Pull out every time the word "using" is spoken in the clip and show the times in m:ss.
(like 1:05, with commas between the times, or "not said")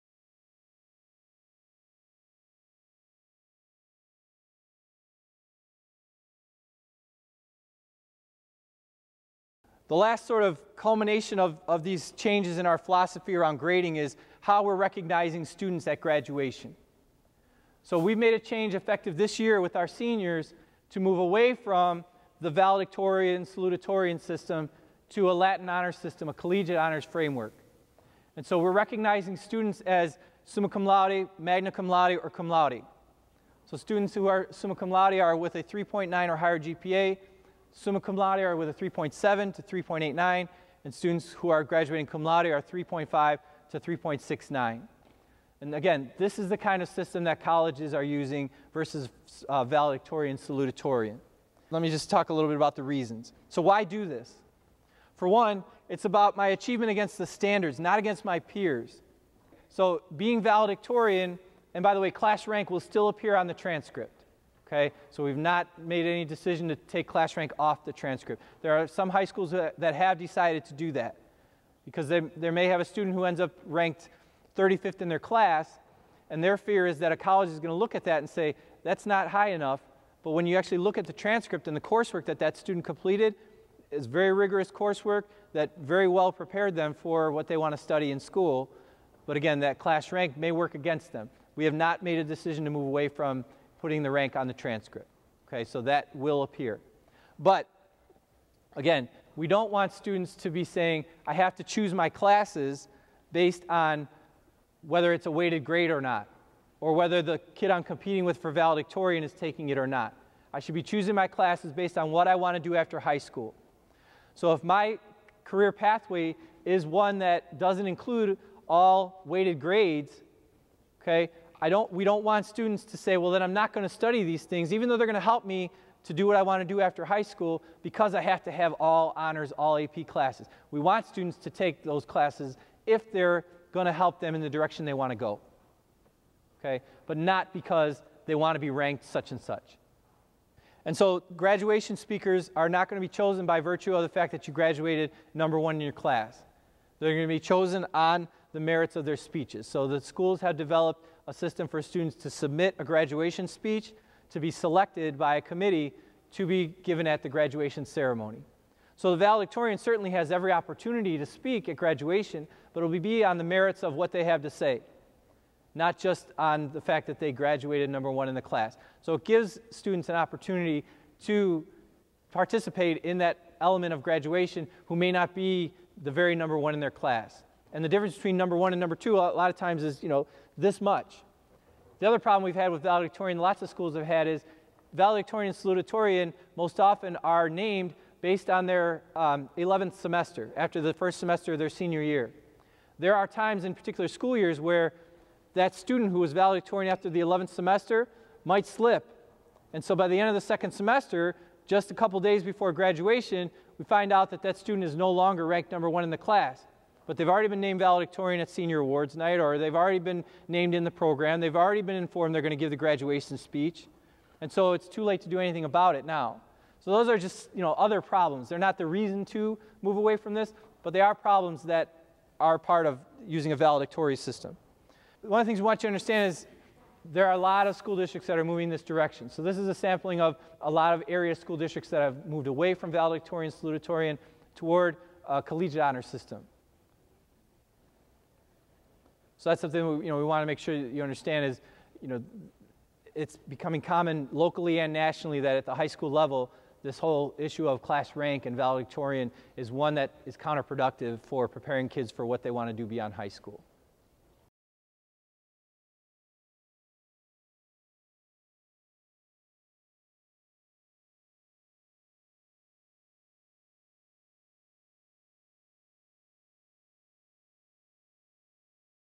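0:48, 3:43.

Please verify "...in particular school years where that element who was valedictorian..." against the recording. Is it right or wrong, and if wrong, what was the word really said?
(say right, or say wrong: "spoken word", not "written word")
wrong: "student", not "element".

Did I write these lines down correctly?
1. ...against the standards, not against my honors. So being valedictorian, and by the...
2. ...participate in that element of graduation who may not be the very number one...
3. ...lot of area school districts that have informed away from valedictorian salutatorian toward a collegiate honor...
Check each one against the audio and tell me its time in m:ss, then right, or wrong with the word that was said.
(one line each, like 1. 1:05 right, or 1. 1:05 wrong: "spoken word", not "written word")
1. 0:56 wrong: "peers", not "honors"
2. 2:52 right
3. 3:50 wrong: "moved", not "informed".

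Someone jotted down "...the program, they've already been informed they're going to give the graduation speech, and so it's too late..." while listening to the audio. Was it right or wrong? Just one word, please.
right.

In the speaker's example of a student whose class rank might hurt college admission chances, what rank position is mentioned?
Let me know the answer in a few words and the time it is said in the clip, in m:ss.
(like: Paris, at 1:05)
35th, at 1:14.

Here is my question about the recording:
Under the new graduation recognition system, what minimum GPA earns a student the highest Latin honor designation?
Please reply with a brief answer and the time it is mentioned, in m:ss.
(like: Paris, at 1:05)
3.9, at 0:35.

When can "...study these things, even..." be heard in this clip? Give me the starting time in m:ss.
2:03.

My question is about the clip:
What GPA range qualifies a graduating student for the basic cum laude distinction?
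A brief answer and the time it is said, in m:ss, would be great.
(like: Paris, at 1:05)
3.5 to 3.69, at 0:42.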